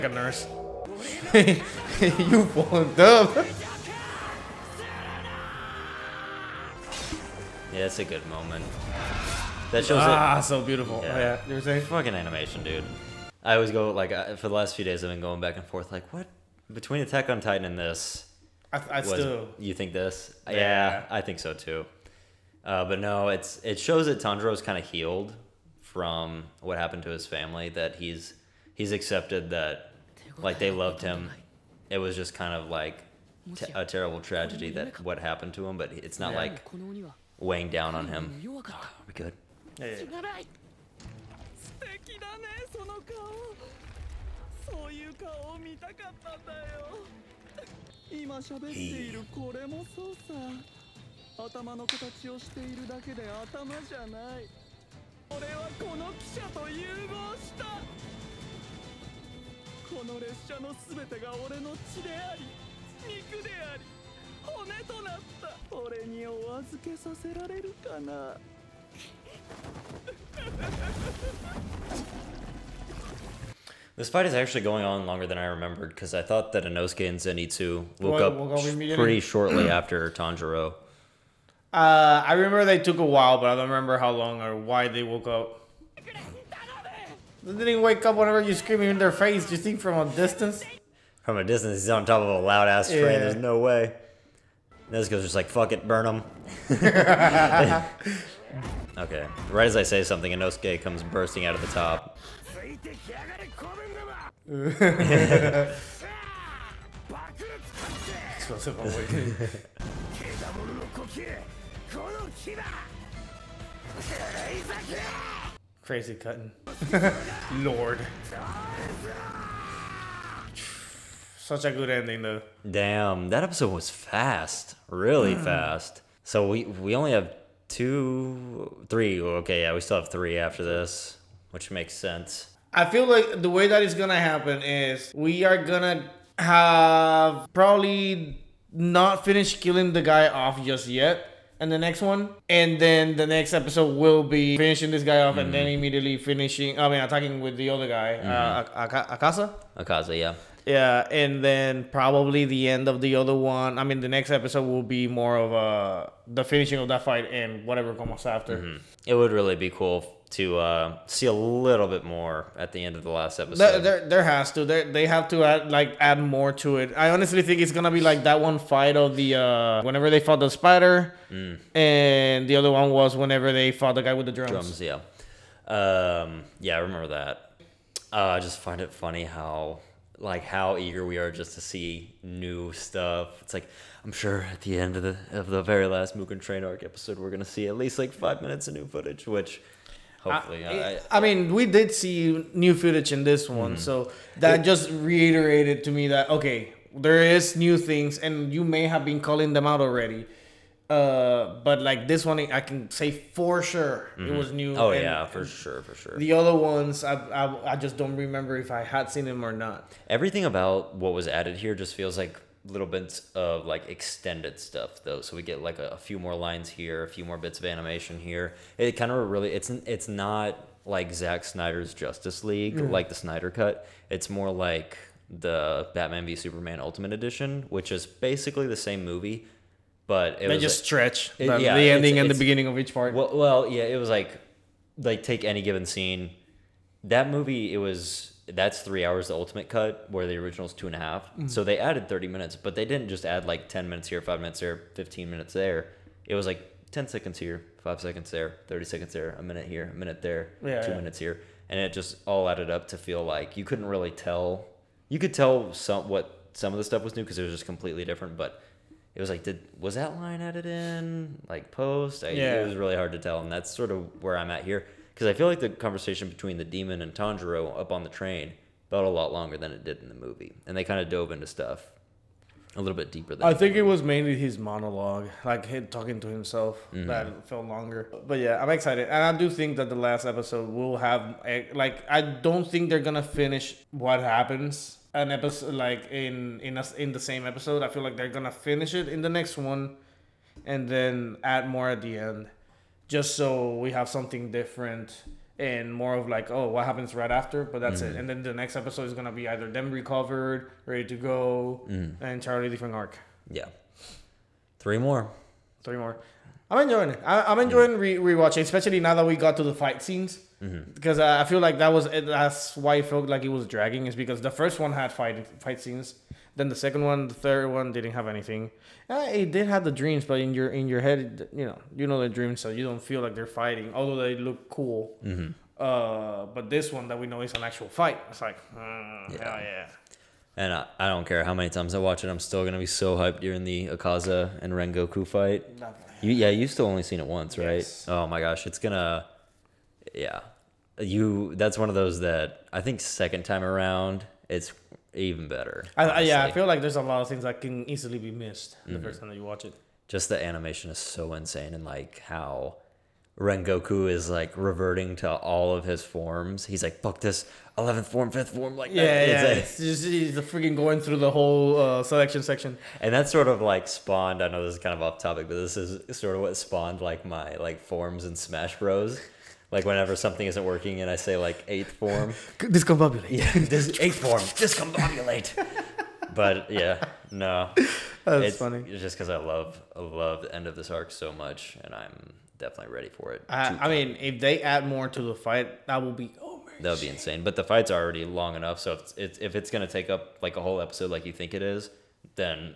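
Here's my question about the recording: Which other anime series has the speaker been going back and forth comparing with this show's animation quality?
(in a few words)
Attack on Titan.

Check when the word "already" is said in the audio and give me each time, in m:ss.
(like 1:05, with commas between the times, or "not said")
3:19, 6:27.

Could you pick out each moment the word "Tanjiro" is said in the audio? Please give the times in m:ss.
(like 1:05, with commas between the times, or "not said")
0:24, 1:20, 4:27.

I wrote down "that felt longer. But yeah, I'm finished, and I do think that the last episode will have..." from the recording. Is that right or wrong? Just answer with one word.
wrong.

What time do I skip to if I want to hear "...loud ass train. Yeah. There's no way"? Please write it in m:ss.
1:32.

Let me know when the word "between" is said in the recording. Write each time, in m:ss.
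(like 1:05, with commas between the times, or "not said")
0:16, 4:26.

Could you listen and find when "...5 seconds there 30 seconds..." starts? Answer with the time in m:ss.
4:07.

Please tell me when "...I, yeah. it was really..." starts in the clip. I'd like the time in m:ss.
4:22.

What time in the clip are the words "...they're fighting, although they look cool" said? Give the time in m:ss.
5:23.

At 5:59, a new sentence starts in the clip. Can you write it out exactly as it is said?
It's, it's just, he's freaking going through the whole uh, selection section.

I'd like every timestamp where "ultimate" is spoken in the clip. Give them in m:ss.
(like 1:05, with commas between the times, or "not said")
3:46, 3:59.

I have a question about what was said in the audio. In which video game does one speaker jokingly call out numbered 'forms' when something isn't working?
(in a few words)
Smash Bros.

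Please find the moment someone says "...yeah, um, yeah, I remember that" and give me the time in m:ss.
2:54.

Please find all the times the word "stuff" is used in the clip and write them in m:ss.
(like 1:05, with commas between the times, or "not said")
3:02, 3:34, 4:16, 4:31.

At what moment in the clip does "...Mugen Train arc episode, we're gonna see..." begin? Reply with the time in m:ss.
3:06.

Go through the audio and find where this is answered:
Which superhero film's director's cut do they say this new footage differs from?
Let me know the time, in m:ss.
3:41.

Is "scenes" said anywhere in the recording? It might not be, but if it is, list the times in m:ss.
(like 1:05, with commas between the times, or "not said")
3:55, 5:10, 5:15.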